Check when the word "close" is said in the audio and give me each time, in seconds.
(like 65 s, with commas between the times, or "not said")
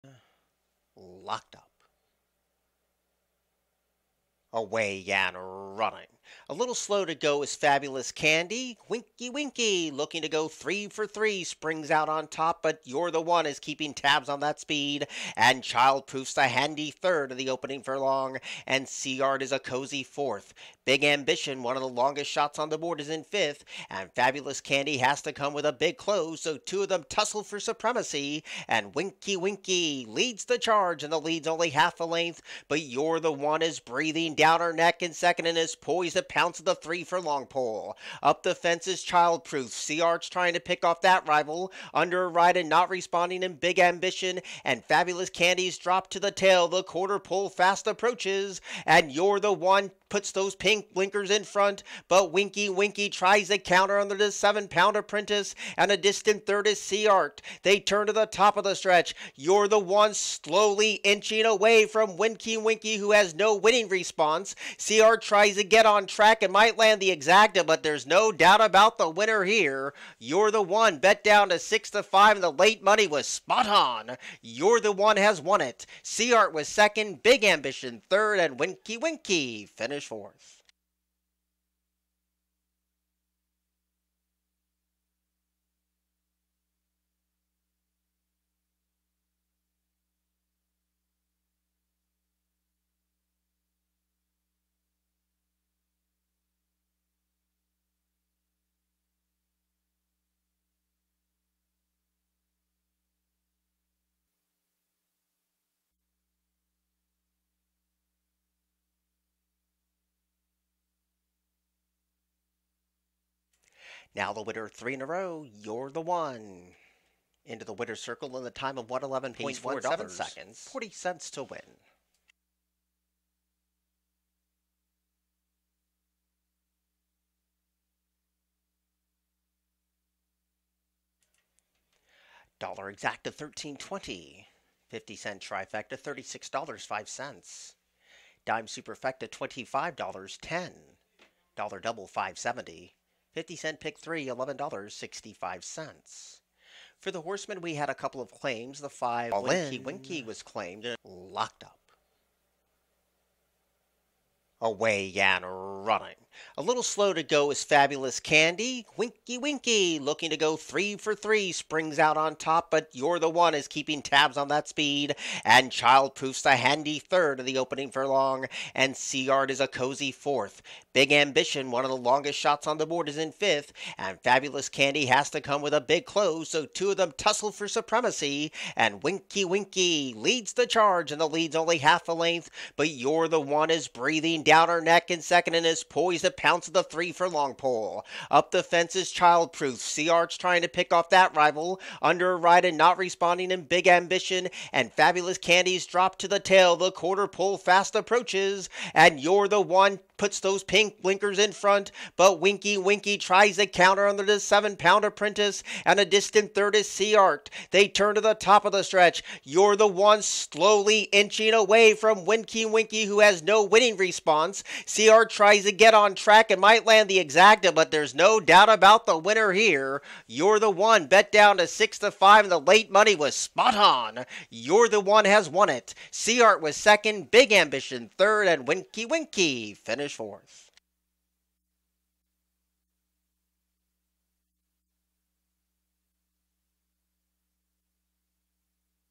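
25 s, 176 s.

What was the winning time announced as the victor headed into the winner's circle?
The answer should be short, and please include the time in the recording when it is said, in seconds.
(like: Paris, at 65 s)
111.17 seconds, at 118 s.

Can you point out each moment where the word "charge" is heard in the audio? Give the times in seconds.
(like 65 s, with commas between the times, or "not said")
30 s, 180 s.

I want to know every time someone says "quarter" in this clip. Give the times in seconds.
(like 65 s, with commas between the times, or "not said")
46 s, 196 s.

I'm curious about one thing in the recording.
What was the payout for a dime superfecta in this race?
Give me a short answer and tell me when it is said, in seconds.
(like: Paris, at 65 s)
$25.10, at 138 s.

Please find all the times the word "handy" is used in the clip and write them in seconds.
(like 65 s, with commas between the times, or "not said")
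16 s, 166 s.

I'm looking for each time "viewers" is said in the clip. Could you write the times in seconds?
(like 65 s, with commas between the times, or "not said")
not said.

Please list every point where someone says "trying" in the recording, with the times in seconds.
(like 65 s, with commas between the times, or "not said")
40 s, 190 s.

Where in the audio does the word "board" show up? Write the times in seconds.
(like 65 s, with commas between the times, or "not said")
22 s, 172 s.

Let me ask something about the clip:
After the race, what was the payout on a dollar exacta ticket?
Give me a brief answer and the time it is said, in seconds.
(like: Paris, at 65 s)
$13.20, at 132 s.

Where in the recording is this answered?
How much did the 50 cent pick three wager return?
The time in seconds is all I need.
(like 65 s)
144 s.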